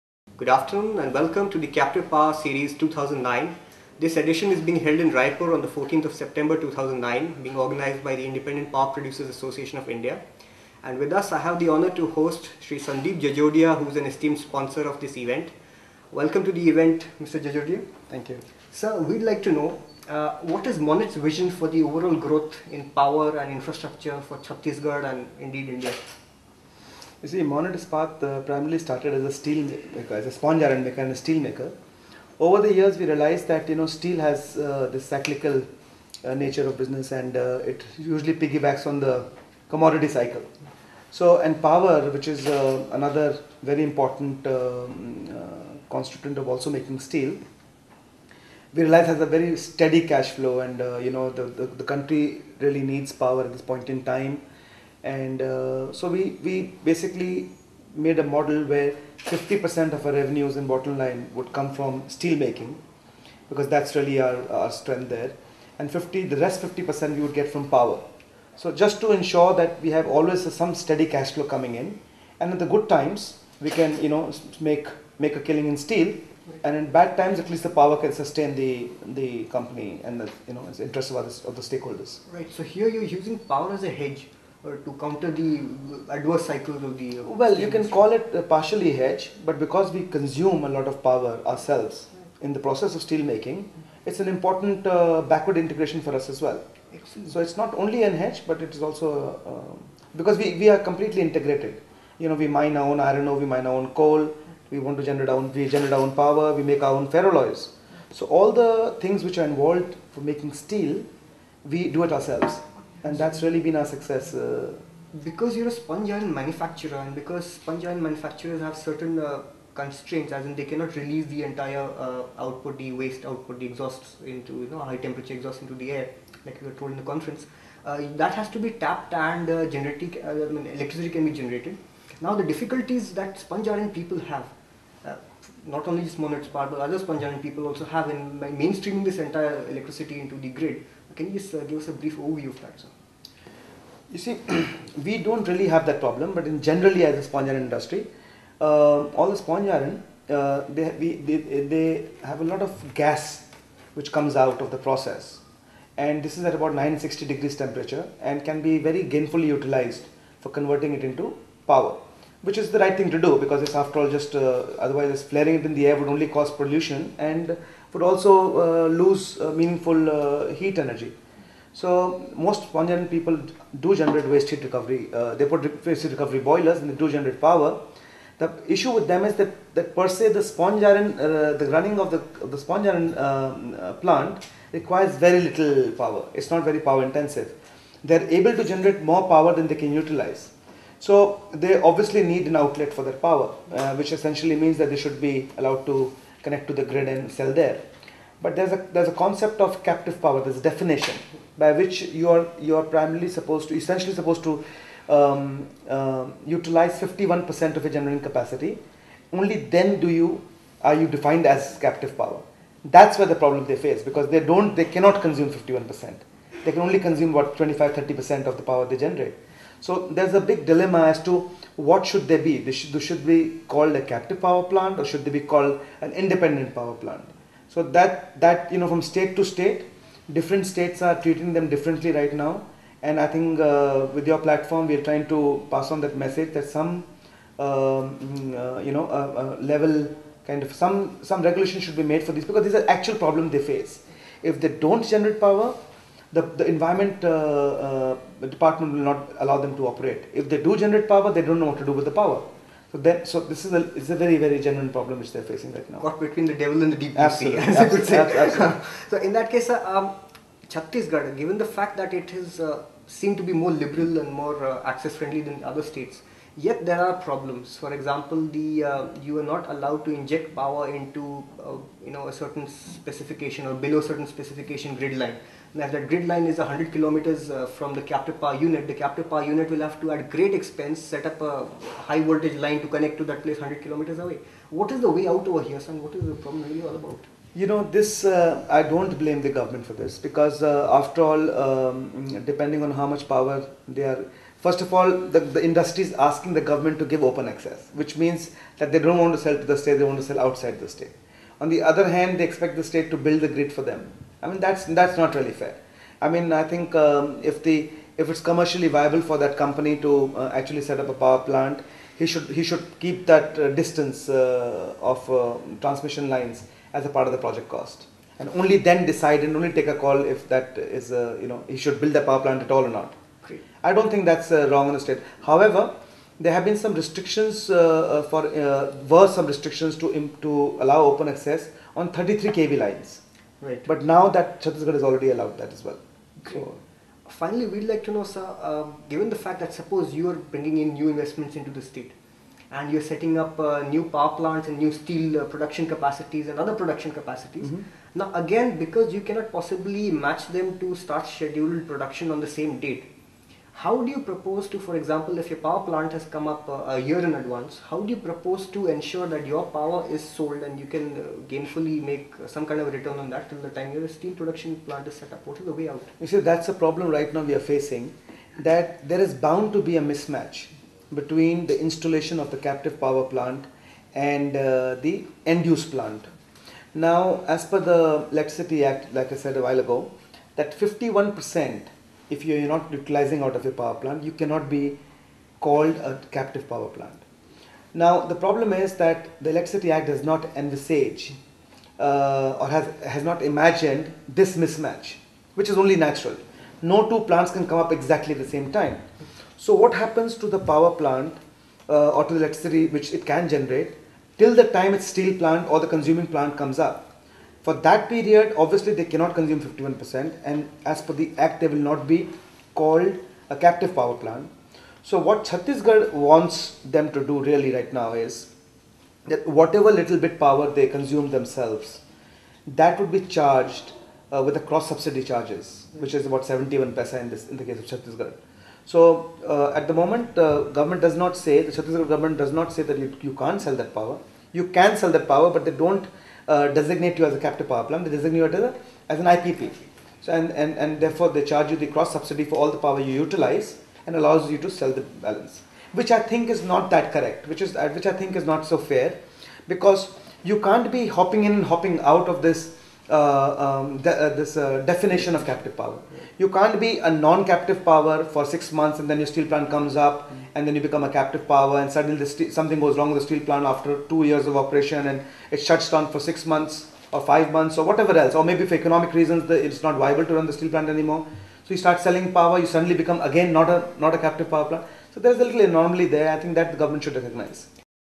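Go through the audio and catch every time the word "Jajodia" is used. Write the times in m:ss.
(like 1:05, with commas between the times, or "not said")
0:13, 0:17.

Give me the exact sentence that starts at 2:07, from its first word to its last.
Uh, that has to be tapped, and uh, generating uh, I mean, electricity can be generated.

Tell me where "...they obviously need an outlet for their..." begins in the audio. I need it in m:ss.
3:11.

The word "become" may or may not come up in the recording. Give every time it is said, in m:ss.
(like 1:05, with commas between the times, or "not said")
7:40, 7:52.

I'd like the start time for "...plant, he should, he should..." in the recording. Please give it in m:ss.
5:11.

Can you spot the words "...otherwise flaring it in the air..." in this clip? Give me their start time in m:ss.
2:44.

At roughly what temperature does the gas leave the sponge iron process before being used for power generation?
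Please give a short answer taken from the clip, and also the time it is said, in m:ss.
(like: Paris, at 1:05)
960 degrees, at 2:36.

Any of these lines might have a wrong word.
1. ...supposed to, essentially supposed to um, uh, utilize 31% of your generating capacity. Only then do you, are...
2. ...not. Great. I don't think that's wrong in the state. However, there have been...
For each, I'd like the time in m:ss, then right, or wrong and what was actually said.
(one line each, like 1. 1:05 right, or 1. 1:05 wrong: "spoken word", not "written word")
1. 3:23 wrong: "51", not "31"
2. 5:22 right.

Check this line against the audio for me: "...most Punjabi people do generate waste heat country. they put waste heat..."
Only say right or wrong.
wrong.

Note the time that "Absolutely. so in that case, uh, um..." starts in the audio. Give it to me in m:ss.
4:18.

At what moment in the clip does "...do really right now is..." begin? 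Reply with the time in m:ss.
6:57.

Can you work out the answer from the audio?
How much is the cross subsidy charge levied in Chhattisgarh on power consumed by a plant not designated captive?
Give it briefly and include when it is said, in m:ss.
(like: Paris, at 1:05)
71 paisa, at 7:06.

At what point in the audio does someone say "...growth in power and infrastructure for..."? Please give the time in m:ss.
0:22.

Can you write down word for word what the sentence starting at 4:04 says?
If they don't generate power, the, the environment uh, uh, the department will not allow them to operate.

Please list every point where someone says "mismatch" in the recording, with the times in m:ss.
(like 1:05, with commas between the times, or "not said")
6:10, 6:34.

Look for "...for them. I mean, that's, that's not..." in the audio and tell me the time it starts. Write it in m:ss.
5:03.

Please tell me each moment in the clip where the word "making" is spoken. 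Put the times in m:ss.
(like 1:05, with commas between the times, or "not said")
0:46, 1:02, 1:33, 1:50.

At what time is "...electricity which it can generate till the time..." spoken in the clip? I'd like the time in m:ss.
6:42.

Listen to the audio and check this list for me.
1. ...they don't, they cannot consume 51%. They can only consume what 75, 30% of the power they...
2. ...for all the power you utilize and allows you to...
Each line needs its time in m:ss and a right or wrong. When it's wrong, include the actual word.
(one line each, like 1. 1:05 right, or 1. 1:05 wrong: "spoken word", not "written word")
1. 3:34 wrong: "25", not "75"
2. 7:22 right.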